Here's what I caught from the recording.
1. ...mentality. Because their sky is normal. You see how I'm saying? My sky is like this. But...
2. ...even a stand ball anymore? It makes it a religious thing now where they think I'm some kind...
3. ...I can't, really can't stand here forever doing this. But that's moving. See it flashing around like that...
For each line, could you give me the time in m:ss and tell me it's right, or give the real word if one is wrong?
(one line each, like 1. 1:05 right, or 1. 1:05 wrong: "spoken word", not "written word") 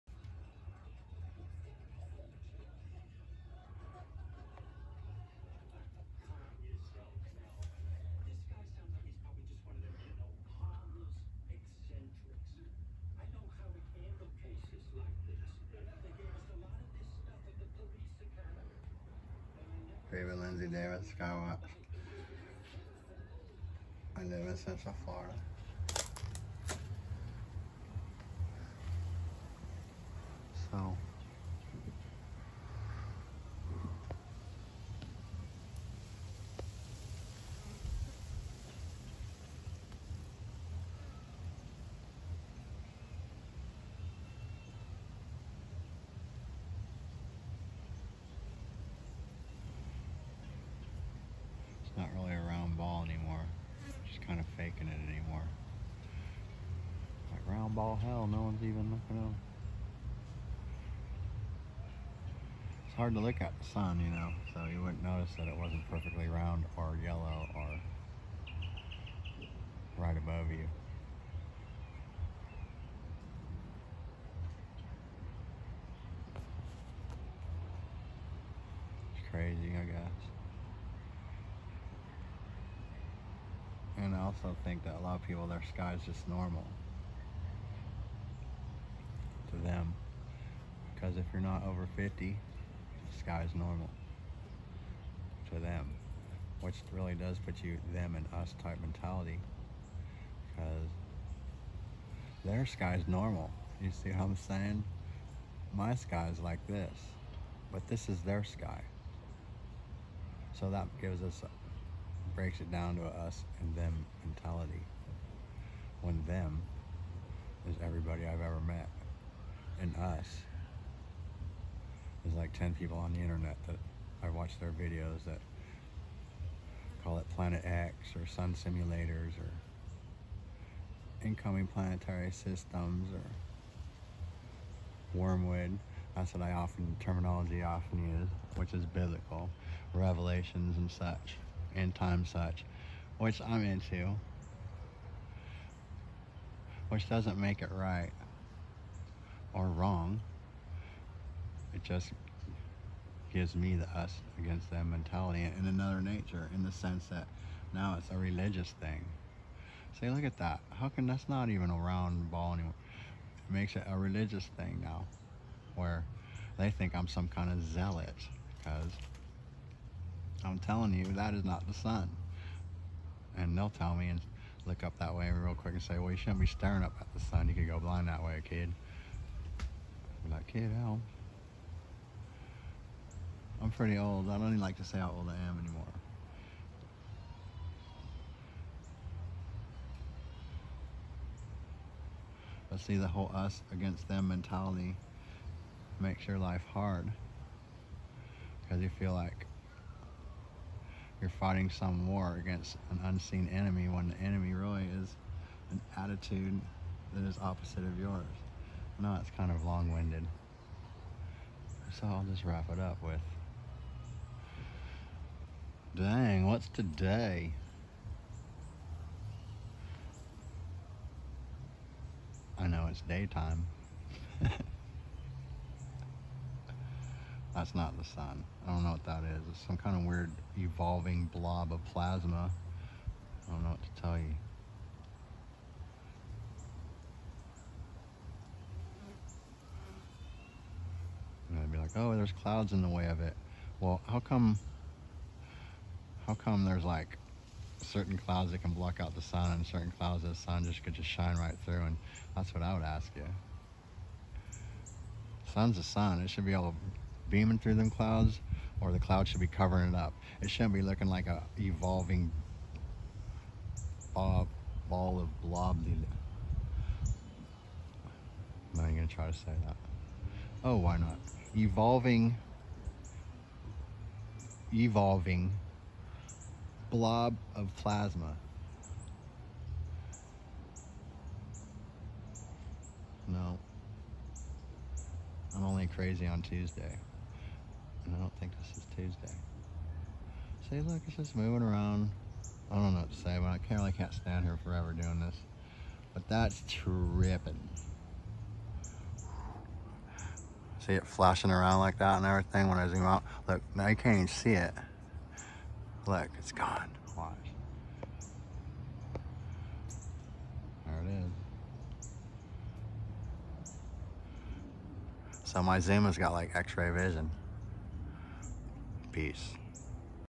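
1. 1:38 right
2. 2:41 wrong: "round", not "stand"
3. 4:53 wrong: "tripping", not "moving".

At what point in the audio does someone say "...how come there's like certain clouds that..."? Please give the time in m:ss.
4:06.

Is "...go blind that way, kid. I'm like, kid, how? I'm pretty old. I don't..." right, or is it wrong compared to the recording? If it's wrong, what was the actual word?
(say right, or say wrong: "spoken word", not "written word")
right.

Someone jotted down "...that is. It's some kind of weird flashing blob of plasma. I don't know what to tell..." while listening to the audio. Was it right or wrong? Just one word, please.
wrong.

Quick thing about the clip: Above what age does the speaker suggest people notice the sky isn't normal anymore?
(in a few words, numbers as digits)
50.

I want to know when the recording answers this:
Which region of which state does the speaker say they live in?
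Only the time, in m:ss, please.
0:24.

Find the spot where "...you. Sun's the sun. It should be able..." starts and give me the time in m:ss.
4:13.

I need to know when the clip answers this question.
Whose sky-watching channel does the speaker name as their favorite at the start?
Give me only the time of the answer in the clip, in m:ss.
0:20.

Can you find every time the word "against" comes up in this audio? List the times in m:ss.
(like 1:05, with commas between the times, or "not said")
2:34, 3:13, 3:22.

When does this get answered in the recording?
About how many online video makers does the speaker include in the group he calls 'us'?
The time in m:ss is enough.
2:02.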